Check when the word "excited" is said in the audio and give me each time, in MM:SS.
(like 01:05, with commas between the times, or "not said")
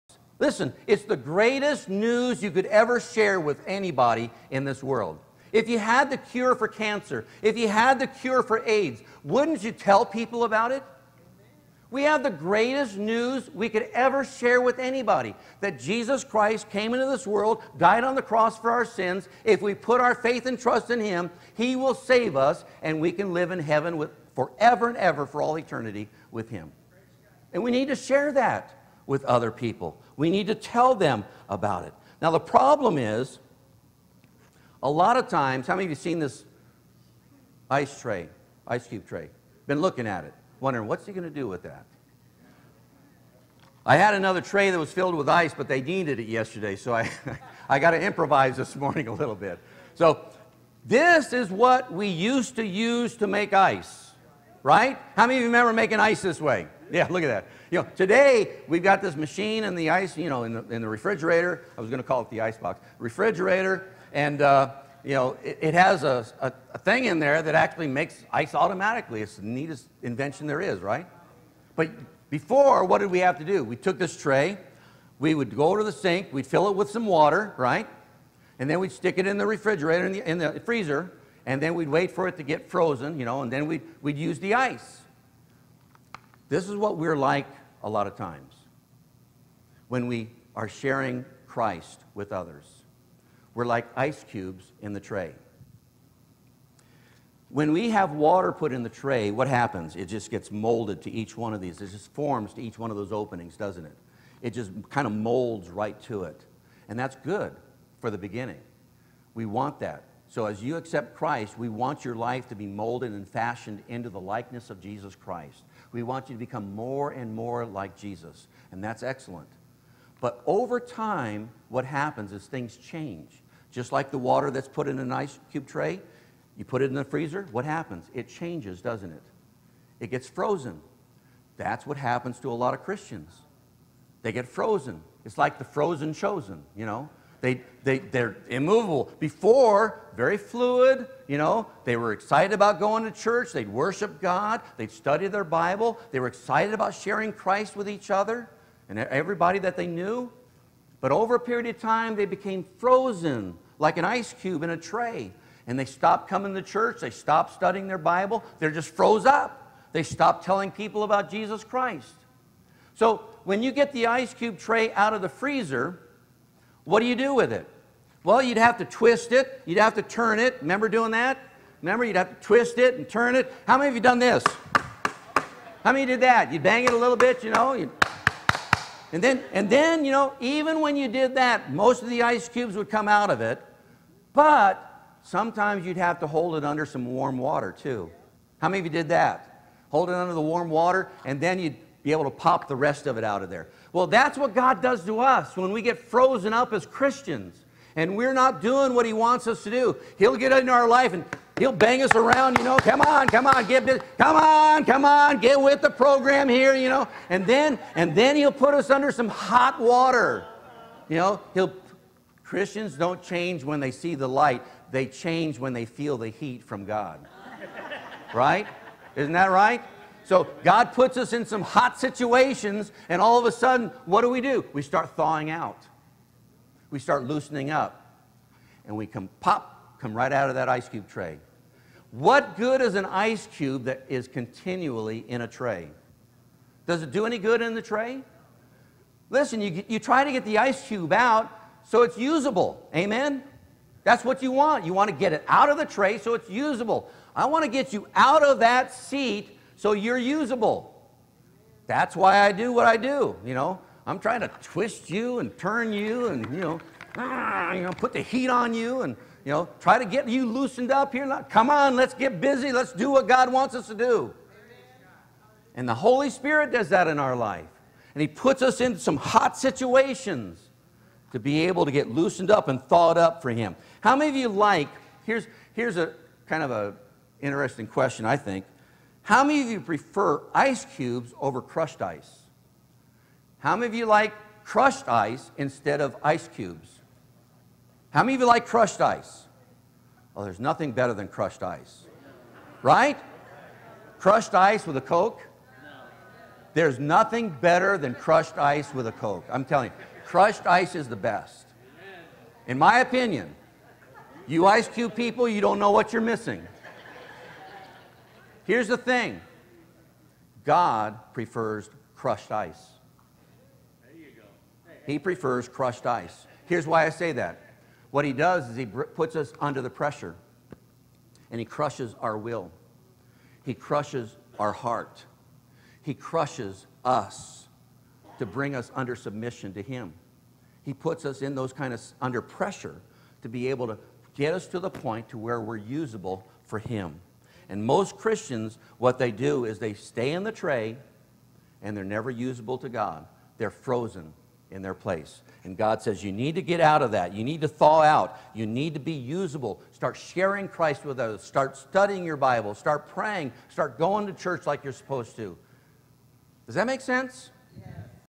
02:22, 02:26.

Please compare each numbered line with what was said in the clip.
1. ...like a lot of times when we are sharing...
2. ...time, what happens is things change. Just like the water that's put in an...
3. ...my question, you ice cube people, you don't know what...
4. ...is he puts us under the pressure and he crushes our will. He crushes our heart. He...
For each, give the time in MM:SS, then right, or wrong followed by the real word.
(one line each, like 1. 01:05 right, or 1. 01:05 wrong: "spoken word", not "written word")
1. 01:27 right
2. 02:00 right
3. 05:02 wrong: "opinion", not "question"
4. 05:18 right.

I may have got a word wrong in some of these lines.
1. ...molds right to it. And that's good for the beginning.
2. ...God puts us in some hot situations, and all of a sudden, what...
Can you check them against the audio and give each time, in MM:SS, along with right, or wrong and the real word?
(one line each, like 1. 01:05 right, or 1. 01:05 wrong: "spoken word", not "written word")
1. 01:45 right
2. 03:40 right.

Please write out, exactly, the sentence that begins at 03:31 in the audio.
You know, He'll, Christians don't change when they see the light, they change when they feel the heat from God.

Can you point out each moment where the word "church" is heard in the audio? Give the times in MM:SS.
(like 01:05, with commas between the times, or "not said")
02:23, 02:36, 05:54.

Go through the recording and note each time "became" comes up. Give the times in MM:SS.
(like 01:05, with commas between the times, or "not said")
02:32.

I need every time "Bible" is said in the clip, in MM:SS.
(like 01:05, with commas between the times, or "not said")
02:25, 02:37, 05:52.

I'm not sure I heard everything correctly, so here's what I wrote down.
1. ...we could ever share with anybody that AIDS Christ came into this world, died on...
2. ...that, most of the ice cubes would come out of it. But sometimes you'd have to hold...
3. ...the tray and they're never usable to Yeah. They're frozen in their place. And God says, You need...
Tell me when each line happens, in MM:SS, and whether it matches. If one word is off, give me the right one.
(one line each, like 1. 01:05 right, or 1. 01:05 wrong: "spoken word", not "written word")
1. 00:13 wrong: "Jesus", not "AIDS"
2. 03:01 right
3. 05:40 wrong: "God", not "Yeah".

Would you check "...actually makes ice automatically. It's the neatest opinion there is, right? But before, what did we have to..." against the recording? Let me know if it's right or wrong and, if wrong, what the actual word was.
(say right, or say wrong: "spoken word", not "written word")
wrong: "invention", not "opinion".